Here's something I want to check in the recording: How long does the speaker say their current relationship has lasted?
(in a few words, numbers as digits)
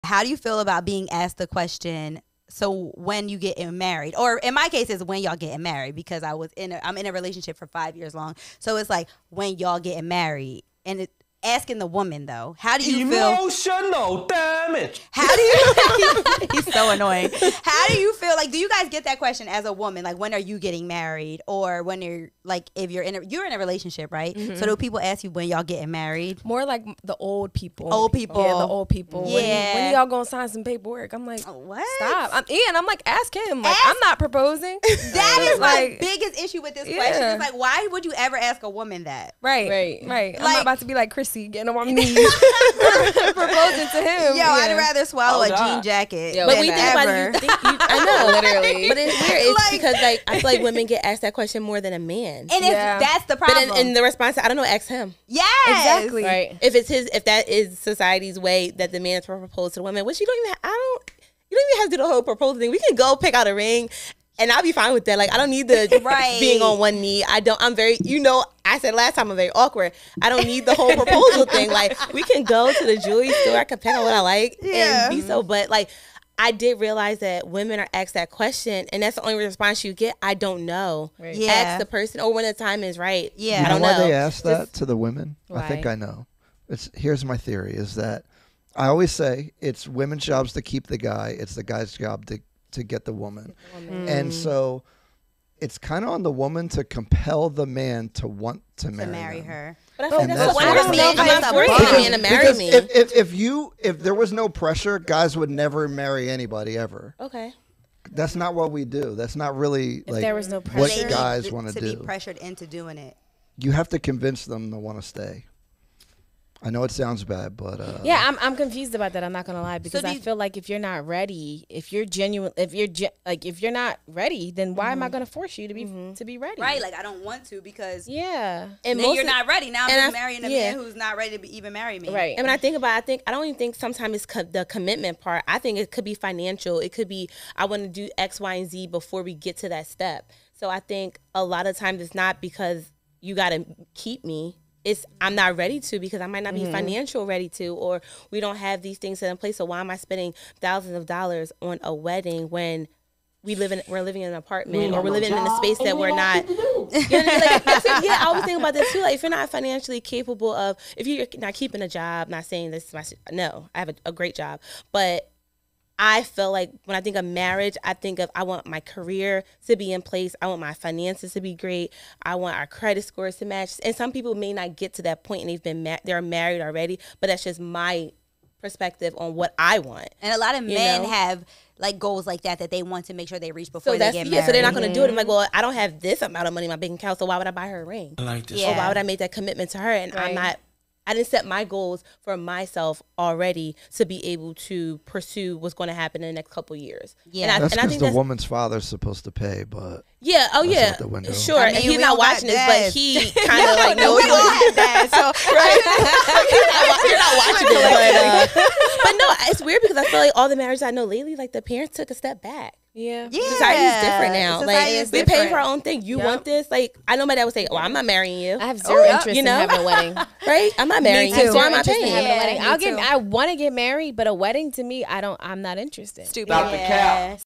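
5 years.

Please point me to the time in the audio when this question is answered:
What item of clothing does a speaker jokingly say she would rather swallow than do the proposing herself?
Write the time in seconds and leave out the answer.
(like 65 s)
45 s.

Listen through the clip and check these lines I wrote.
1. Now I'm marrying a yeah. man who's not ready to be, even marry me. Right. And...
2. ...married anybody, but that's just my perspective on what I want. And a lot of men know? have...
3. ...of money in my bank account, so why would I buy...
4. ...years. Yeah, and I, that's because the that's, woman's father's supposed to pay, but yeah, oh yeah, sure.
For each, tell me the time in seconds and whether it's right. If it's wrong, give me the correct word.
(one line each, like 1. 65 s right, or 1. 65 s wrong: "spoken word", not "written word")
1. 129 s right
2. 176 s wrong: "already", not "anybody"
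3. 186 s right
4. 196 s right.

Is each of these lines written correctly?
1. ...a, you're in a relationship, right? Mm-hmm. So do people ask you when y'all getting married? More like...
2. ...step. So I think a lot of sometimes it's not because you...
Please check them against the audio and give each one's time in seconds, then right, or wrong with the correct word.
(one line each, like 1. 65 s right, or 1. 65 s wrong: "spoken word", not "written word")
1. 23 s right
2. 139 s wrong: "times", not "sometimes".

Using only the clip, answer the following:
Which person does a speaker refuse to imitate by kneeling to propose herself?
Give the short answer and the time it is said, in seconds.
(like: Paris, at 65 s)
Chrissy, at 41 s.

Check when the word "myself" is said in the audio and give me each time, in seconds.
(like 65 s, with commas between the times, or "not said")
192 s.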